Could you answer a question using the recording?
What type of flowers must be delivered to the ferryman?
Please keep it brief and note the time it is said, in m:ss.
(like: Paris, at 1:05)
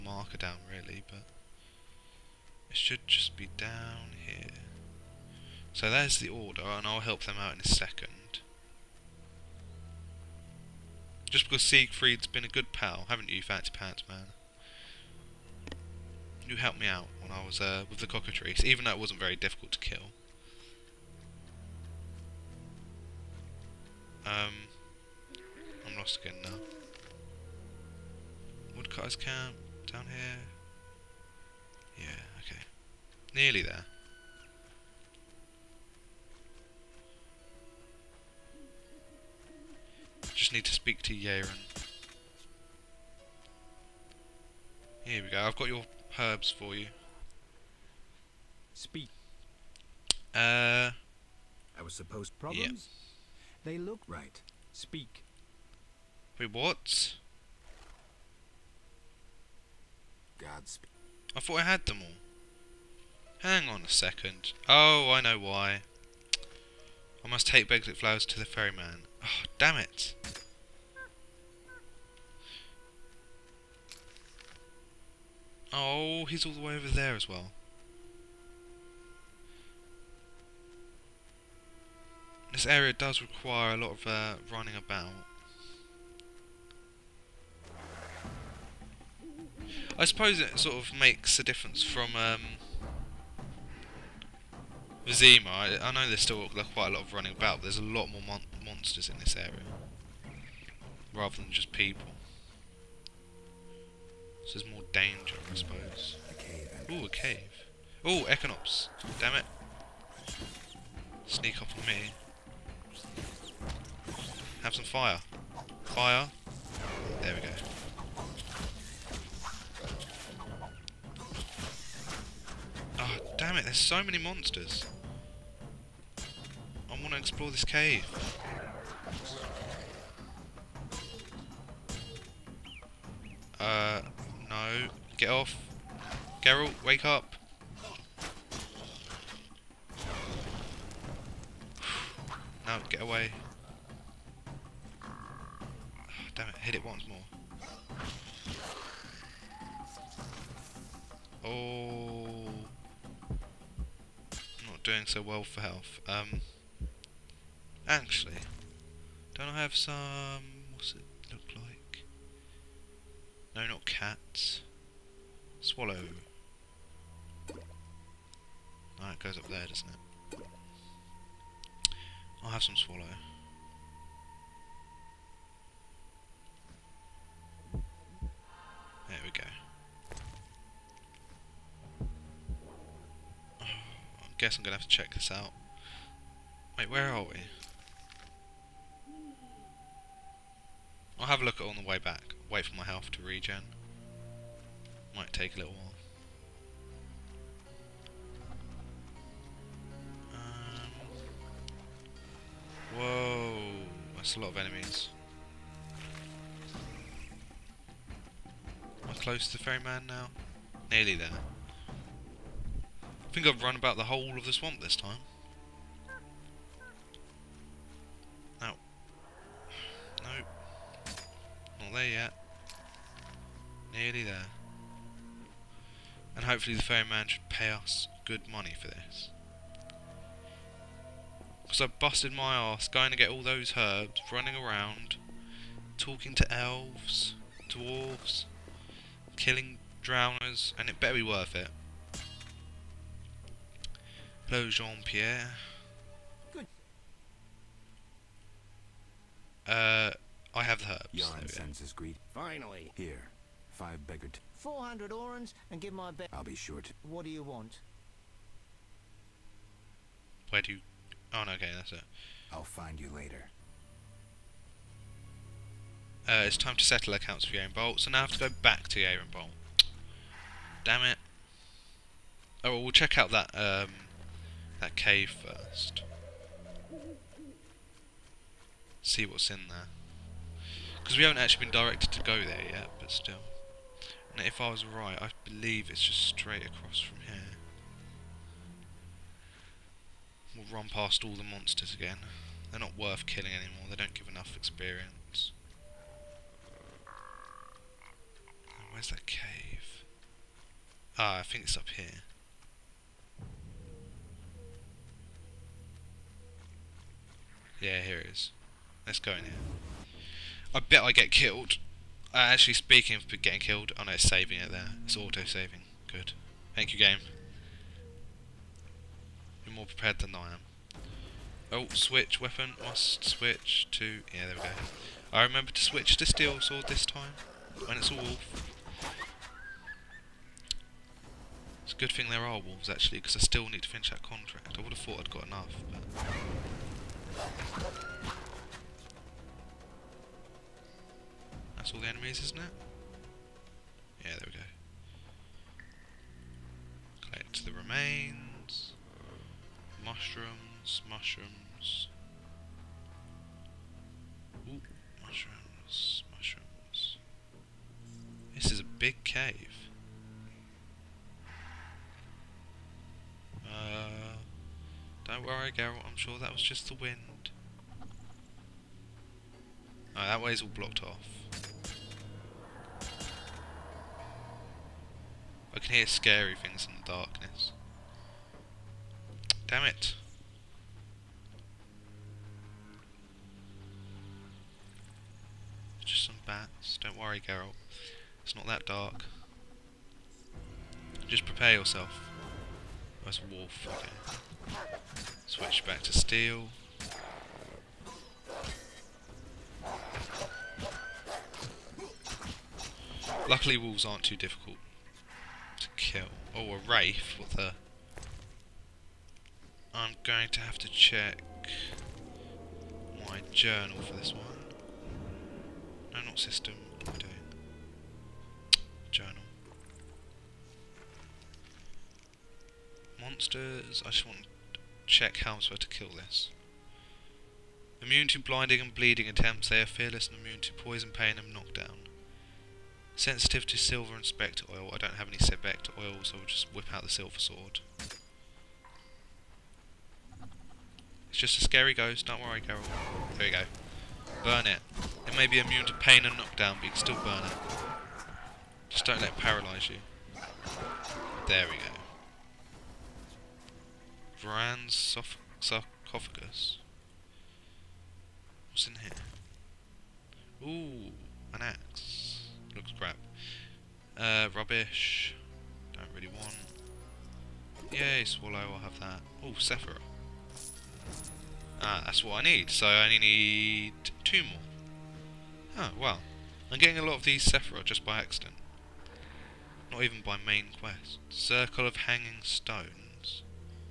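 Beglet flowers, at 1:07.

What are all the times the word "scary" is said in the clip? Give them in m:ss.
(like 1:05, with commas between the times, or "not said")
6:16, 7:21.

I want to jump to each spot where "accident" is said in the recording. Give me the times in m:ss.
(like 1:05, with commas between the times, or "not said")
7:58.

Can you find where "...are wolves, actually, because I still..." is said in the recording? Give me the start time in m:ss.
5:32.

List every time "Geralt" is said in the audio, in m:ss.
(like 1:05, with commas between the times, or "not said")
2:16, 6:05, 6:27.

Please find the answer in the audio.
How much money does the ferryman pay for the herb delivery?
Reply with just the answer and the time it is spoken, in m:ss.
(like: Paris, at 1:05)
400 orens, at 4:14.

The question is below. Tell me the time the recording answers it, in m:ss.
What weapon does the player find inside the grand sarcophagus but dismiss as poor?
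7:41.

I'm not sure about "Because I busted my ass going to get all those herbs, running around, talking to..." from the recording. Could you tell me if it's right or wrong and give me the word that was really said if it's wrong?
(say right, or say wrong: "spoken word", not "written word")
right.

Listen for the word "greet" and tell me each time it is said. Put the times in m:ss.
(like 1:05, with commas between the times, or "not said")
4:11.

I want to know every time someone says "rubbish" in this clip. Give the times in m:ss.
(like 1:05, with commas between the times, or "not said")
7:44.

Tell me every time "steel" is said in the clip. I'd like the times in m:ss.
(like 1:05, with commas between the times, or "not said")
5:26, 6:36.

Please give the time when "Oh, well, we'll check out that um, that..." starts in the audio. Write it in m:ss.
4:32.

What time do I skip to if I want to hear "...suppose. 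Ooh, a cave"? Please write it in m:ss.
1:45.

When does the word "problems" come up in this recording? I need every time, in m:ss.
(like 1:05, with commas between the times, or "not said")
0:52.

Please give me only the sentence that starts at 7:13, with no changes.
Sensitive to silver and spectre oil.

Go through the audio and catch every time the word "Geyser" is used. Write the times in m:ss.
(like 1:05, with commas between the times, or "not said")
not said.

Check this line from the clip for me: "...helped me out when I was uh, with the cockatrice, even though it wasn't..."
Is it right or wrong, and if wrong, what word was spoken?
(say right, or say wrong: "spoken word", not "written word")
right.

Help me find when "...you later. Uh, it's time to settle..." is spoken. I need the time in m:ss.
4:23.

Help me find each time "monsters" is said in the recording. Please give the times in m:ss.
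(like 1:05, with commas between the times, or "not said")
1:38, 2:04, 4:51, 7:03.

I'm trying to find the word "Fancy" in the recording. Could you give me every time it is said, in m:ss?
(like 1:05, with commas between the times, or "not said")
0:13.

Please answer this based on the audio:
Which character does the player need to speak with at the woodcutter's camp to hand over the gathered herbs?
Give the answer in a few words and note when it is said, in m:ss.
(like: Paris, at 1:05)
Yaren, at 0:41.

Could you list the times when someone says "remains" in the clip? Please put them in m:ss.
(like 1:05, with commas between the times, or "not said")
5:47.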